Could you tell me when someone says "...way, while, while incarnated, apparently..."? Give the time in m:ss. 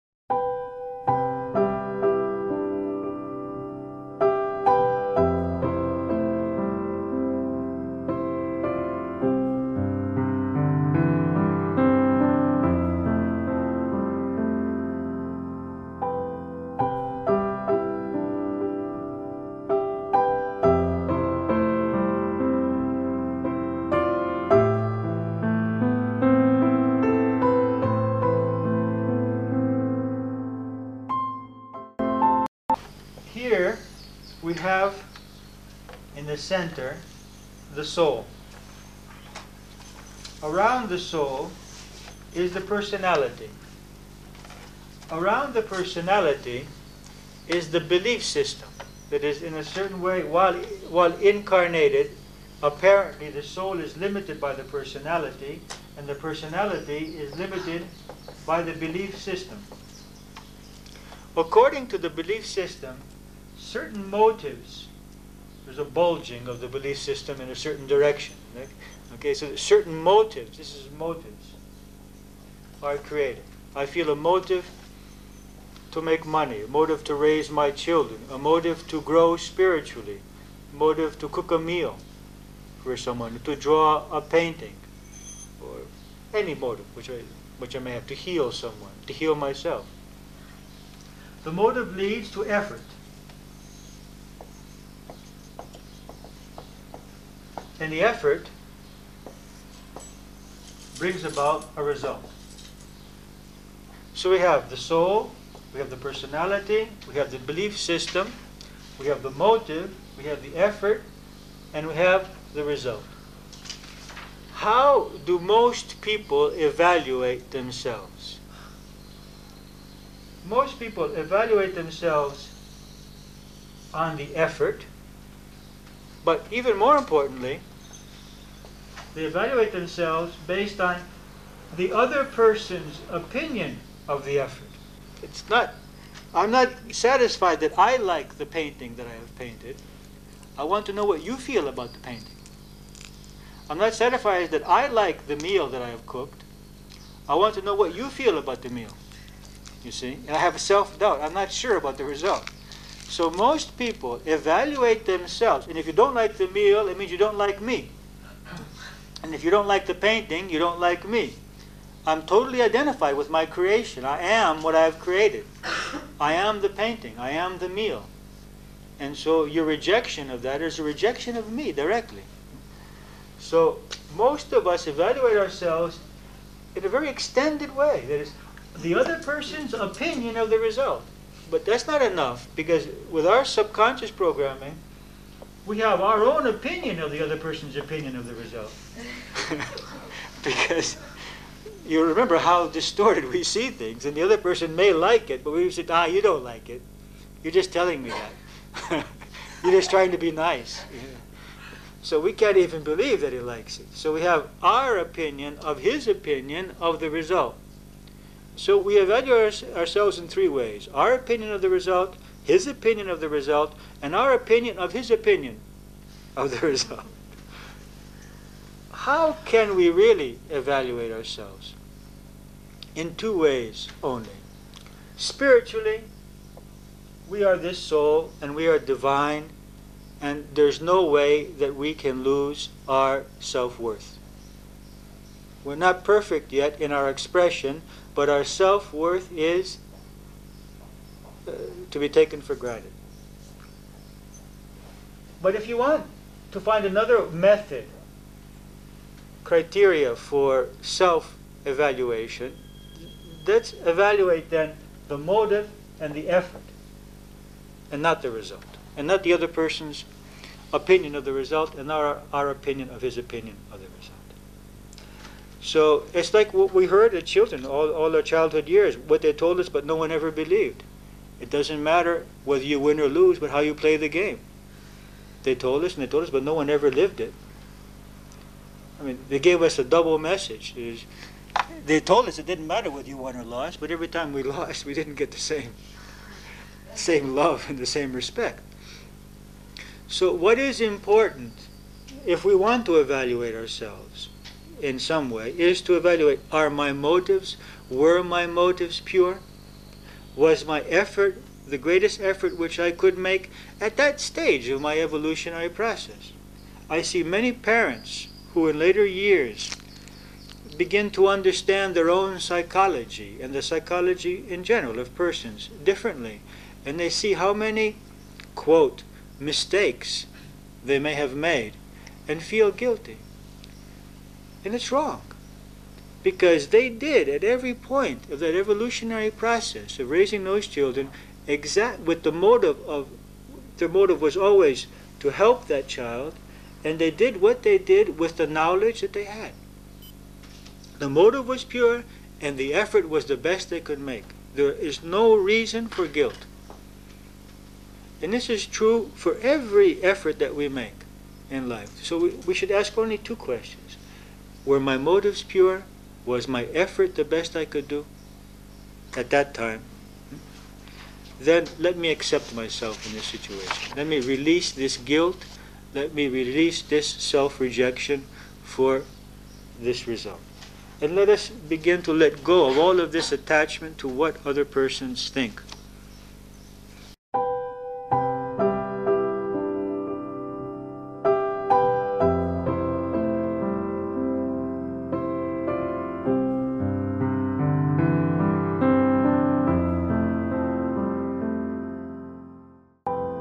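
0:50.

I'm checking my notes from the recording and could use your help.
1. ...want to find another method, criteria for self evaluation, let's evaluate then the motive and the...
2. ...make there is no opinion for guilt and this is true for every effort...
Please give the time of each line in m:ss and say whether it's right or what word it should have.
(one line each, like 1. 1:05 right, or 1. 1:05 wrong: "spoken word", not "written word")
1. 4:05 right
2. 5:43 wrong: "reason", not "opinion".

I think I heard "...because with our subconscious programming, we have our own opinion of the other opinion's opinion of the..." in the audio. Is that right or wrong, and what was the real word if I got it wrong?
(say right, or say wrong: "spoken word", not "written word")
wrong: "person", not "opinion".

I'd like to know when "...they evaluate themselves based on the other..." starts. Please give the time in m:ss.
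2:09.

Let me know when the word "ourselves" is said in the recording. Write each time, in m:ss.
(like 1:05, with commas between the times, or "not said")
2:55, 3:29, 3:41, 4:53.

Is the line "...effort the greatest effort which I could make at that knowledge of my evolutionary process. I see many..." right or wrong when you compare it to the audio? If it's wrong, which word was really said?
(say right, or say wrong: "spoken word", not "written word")
wrong: "stage", not "knowledge".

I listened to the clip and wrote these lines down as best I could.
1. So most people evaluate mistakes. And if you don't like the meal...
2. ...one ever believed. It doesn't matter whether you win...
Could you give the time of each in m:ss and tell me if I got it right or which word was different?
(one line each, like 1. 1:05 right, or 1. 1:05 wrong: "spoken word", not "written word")
1. 2:33 wrong: "themselves", not "mistakes"
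2. 4:29 right.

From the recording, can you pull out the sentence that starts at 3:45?
Spiritually, we are this soul and we are divine, and there's no way that we can lose our self worth.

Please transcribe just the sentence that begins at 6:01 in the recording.
Then let me accept myself in this situation.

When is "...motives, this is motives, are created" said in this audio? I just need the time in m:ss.
1:09.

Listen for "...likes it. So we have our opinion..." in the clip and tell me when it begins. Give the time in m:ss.
3:23.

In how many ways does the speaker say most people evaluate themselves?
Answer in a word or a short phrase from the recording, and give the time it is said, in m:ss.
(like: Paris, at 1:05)
3, at 3:30.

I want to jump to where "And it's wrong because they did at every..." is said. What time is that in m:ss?
5:24.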